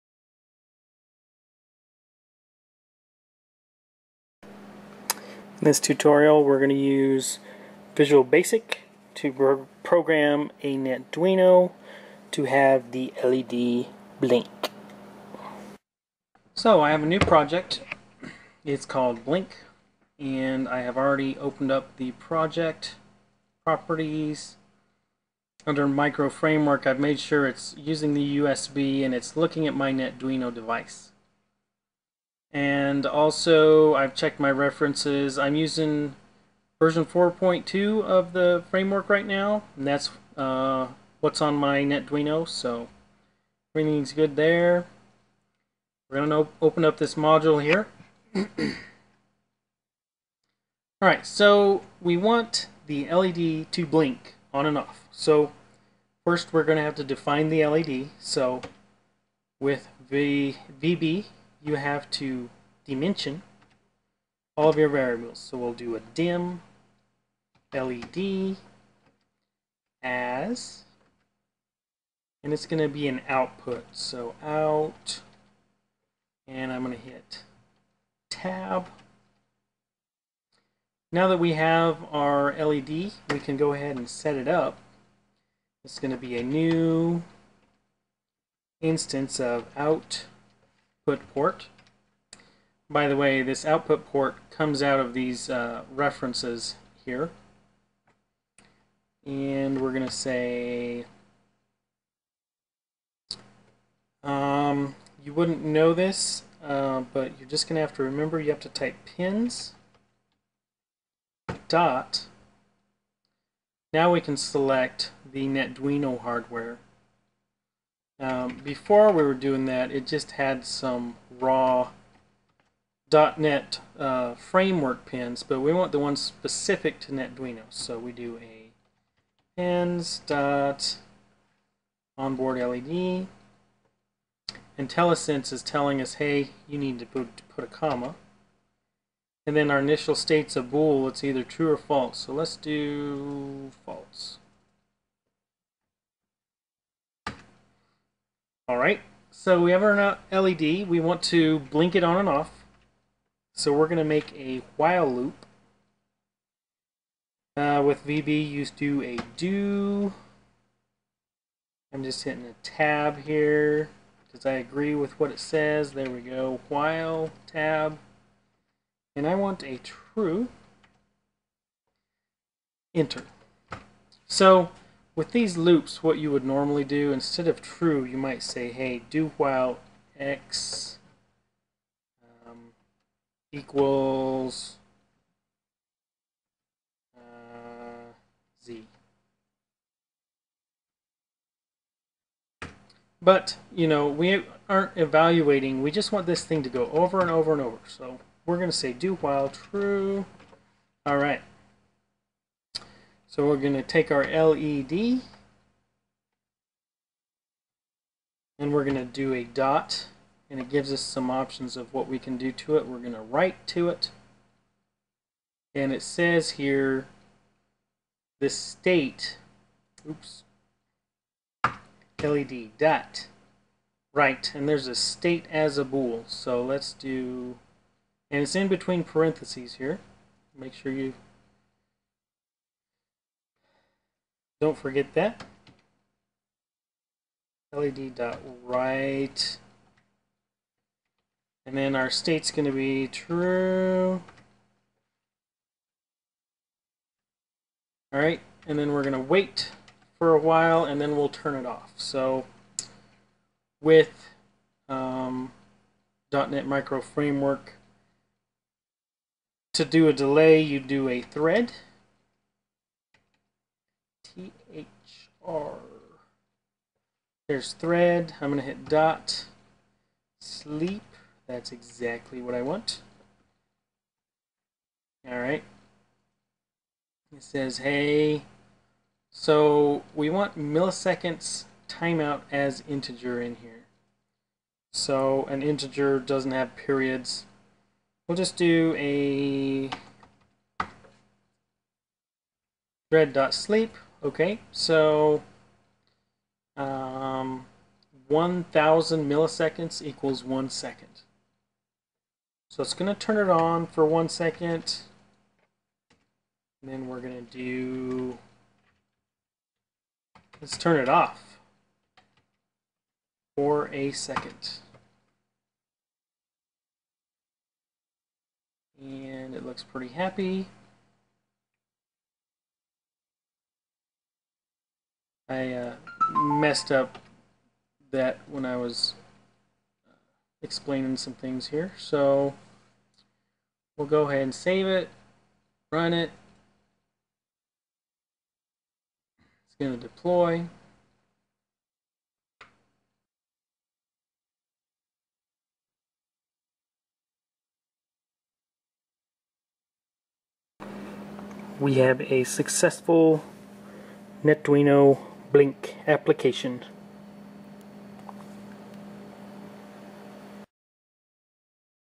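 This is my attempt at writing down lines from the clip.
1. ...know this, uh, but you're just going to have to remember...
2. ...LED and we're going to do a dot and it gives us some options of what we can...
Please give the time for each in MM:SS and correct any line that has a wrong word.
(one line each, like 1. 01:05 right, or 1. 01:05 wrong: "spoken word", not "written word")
1. 01:45 right
2. 03:24 right.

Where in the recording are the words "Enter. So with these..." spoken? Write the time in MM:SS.
02:52.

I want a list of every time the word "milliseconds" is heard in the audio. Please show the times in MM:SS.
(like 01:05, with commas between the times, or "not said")
04:40, 04:59.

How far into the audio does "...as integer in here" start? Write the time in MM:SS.
04:42.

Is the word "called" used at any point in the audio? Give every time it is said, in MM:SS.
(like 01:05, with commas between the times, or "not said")
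00:18.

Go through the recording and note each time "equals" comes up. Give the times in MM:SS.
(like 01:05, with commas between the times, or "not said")
03:03, 05:00.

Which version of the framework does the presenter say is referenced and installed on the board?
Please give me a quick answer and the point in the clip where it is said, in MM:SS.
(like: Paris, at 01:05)
4.2, at 00:36.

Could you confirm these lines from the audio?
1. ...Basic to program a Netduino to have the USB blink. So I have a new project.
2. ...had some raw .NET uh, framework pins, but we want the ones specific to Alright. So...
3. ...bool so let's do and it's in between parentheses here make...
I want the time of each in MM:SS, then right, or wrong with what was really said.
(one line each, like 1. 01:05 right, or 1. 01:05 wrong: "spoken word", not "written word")
1. 00:08 wrong: "LED", not "USB"
2. 02:00 wrong: "NetDuino", not "Alright"
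3. 03:45 right.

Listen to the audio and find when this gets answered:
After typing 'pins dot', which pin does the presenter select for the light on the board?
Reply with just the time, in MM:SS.
02:12.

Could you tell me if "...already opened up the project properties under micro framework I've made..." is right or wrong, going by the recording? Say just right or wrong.
right.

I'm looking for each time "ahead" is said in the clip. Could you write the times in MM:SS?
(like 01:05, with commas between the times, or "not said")
01:23, 05:34.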